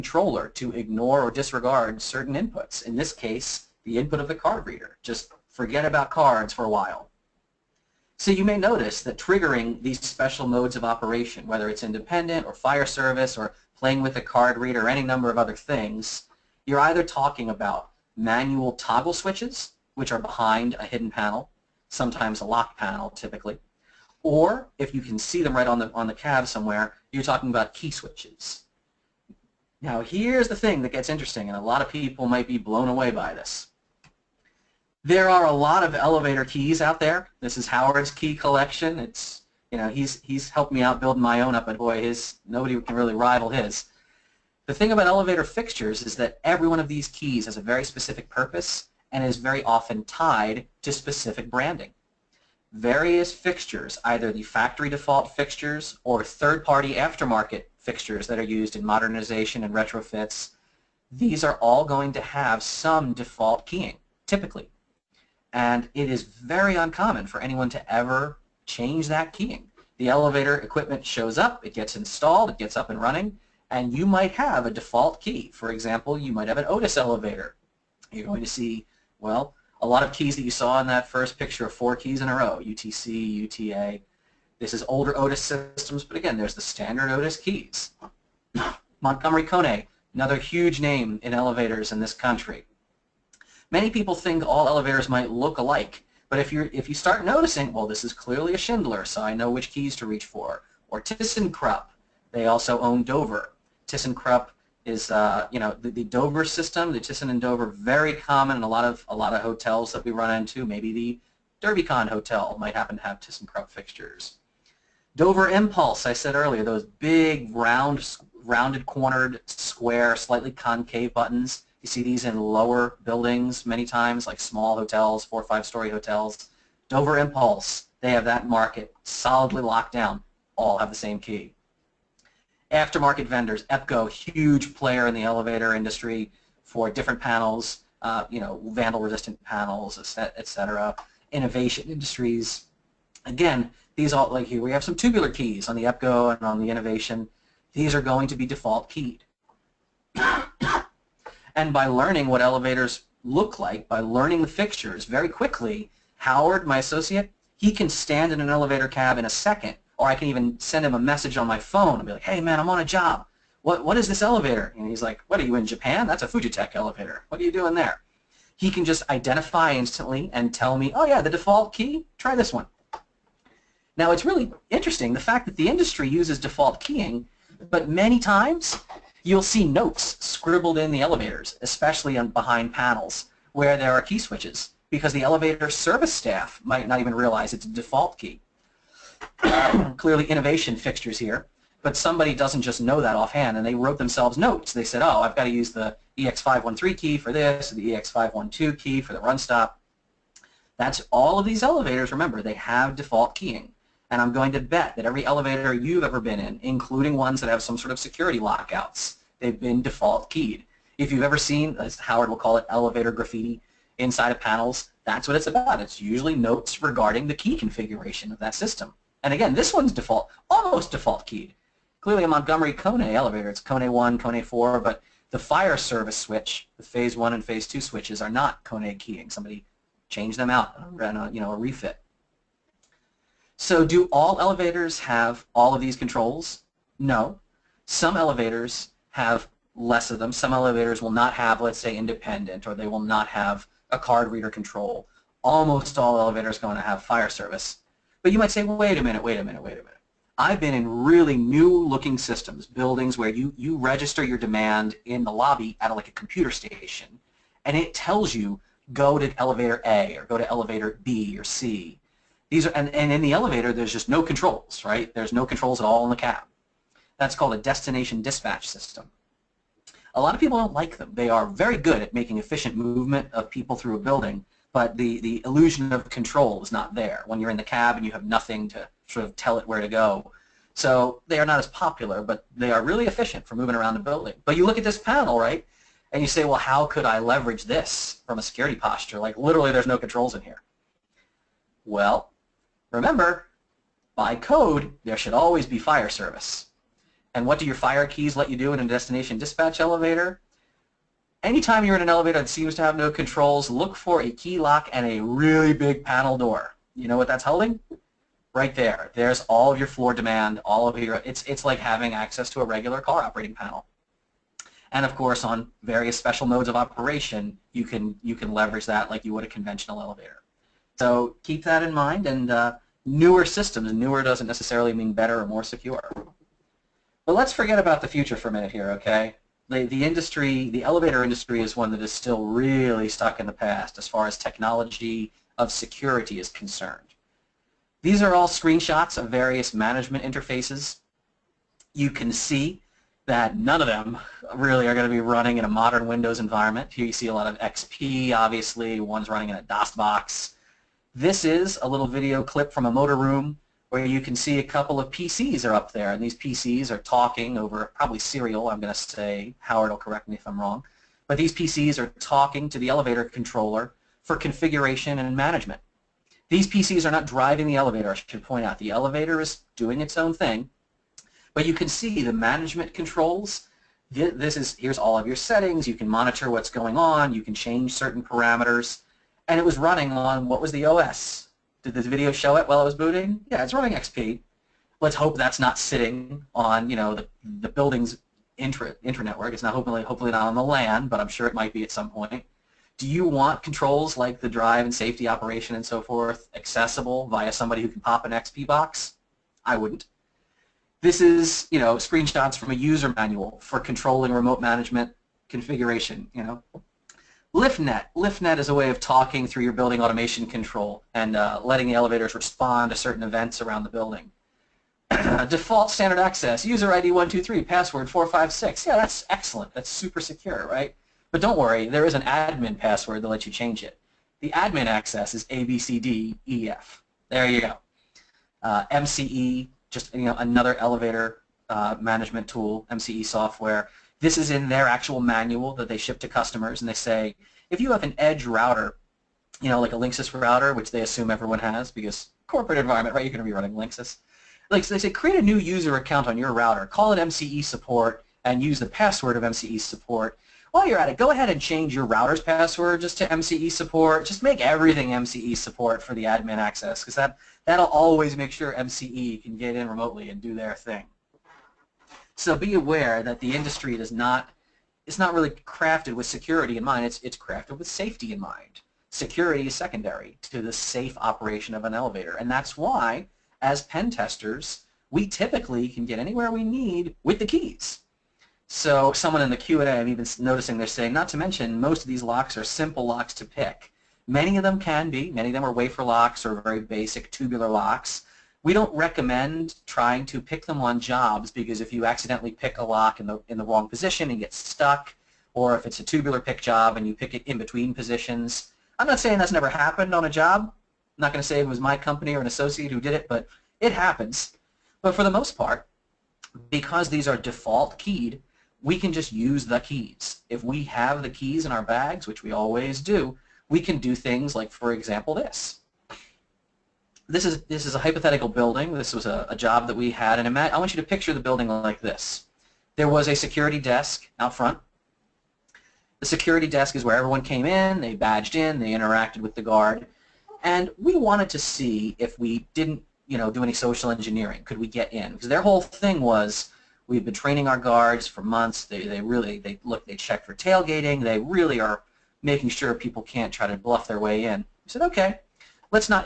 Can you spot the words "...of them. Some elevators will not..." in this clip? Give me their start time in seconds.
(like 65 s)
240 s.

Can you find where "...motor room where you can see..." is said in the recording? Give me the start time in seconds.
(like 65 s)
352 s.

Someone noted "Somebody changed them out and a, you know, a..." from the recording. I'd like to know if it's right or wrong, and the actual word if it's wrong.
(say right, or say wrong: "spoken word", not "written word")
right.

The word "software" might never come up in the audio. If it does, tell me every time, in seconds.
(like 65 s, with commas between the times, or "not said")
433 s.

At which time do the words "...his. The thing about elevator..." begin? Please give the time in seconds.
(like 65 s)
43 s.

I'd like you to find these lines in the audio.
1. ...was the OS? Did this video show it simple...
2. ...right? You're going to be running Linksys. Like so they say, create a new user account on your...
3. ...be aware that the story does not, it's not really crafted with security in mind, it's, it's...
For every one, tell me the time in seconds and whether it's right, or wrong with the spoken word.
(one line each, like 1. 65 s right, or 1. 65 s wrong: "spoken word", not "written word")
1. 380 s wrong: "while", not "simple"
2. 443 s right
3. 462 s wrong: "industry", not "story".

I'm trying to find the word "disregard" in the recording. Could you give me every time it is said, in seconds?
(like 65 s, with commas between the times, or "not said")
1 s.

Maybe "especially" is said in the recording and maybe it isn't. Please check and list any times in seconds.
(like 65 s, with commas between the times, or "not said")
181 s.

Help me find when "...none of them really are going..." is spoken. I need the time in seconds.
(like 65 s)
343 s.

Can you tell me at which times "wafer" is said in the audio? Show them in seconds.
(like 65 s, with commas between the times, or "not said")
485 s.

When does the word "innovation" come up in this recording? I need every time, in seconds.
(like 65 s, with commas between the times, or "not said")
141 s, 146 s, 190 s.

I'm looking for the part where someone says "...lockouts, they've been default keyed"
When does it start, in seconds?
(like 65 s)
208 s.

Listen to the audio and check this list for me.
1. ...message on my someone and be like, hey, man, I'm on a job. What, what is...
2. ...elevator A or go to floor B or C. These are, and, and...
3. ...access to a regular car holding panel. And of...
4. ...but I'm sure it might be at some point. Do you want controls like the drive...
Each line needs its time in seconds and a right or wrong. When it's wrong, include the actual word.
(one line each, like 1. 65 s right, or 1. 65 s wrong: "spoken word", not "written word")
1. 160 s wrong: "phone", not "someone"
2. 259 s wrong: "elevator", not "floor"
3. 312 s wrong: "operating", not "holding"
4. 391 s right.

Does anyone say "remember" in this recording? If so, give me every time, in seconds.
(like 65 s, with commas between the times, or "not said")
202 s, 292 s.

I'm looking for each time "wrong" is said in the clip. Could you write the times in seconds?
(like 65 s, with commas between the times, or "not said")
360 s, 493 s.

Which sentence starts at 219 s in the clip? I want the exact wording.
And again, this one's default, almost default keyed.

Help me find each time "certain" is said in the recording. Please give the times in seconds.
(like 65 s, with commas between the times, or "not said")
2 s, 377 s, 412 s.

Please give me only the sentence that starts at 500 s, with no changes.
I'm not going to say it was my company or an associate who did it, but it happens.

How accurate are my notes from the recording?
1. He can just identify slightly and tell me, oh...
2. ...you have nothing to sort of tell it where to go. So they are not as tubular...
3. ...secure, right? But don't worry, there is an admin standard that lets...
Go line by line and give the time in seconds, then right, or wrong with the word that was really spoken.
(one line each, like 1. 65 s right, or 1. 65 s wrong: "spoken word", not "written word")
1. 168 s wrong: "instantly", not "slightly"
2. 278 s wrong: "popular", not "tubular"
3. 420 s wrong: "password", not "standard".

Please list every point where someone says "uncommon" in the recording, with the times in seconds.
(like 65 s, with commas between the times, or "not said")
66 s.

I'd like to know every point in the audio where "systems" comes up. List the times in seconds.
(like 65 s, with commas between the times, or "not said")
85 s, 106 s, 218 s, 252 s, 268 s, 323 s.